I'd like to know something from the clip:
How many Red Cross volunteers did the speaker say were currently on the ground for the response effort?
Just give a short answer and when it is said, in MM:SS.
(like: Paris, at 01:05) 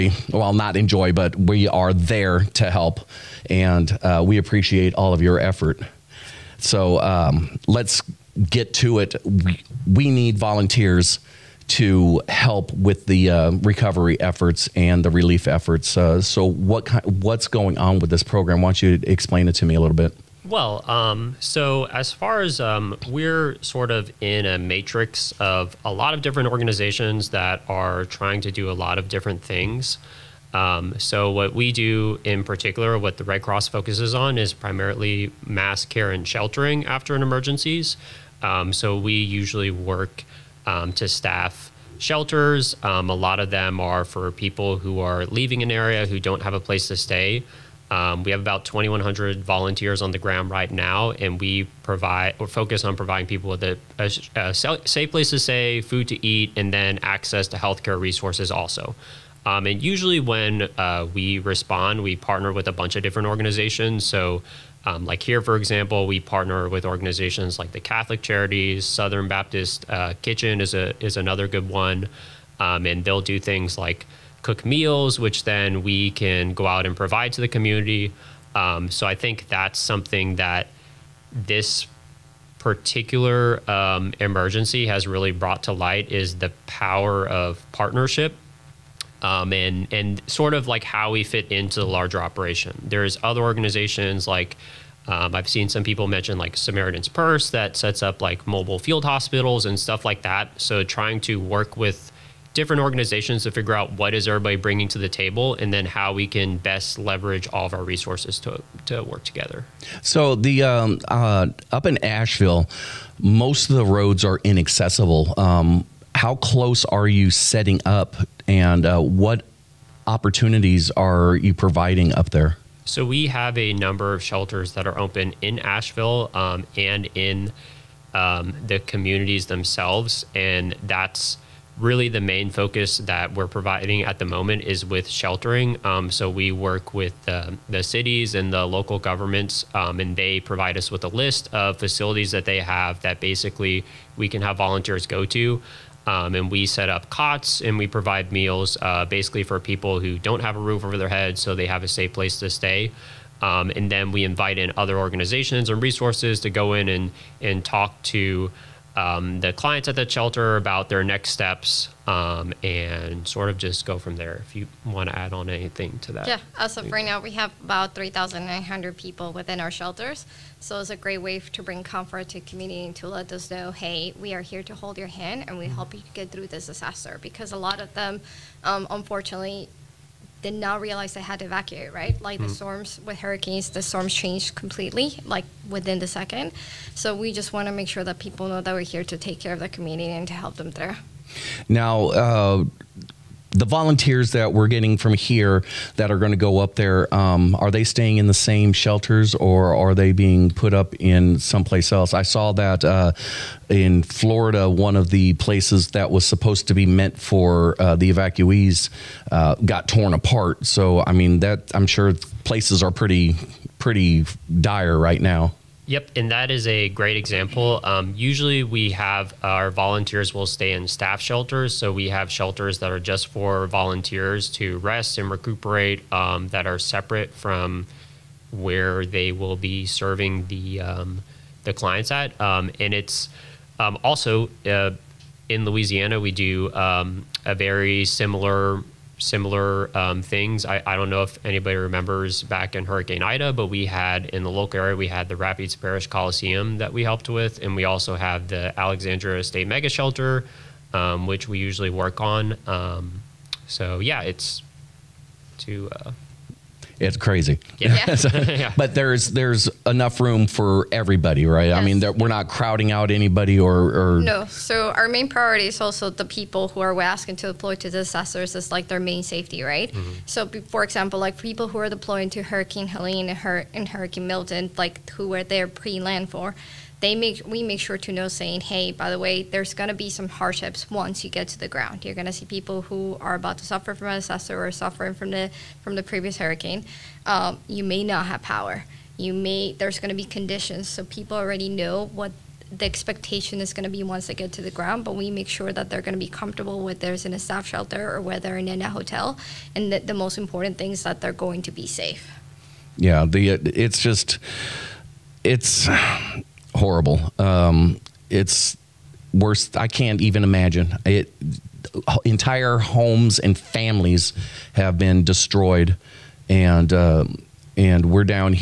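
2,100, at 00:48.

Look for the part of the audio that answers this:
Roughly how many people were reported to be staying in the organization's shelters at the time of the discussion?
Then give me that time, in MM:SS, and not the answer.
02:47.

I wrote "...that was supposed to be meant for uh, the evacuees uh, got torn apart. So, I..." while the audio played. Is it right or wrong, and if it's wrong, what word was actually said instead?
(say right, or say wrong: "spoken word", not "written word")
right.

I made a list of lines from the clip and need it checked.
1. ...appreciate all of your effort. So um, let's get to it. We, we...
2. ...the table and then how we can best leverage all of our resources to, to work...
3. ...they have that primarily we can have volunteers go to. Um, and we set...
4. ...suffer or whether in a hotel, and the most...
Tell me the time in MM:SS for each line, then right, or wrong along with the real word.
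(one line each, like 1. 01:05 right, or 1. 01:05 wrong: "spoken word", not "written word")
1. 00:04 right
2. 01:44 right
3. 02:22 wrong: "basically", not "primarily"
4. 04:57 wrong: "shelter", not "suffer".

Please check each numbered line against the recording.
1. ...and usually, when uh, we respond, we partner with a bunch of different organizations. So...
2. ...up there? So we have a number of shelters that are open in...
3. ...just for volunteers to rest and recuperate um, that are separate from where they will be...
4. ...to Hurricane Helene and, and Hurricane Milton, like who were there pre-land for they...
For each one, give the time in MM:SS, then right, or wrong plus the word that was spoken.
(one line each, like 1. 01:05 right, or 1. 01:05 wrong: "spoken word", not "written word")
1. 00:59 right
2. 02:02 right
3. 03:42 right
4. 04:32 right.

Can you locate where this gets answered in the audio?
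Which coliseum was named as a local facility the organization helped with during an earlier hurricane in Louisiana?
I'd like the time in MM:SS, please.
04:05.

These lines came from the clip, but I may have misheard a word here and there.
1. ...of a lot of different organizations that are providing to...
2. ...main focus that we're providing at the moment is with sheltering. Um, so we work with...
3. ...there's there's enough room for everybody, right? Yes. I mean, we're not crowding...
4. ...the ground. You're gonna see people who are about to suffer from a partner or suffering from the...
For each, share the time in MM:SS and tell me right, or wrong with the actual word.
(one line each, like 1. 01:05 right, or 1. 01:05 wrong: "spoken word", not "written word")
1. 00:25 wrong: "trying", not "providing"
2. 02:12 right
3. 04:18 right
4. 04:41 wrong: "disaster", not "partner".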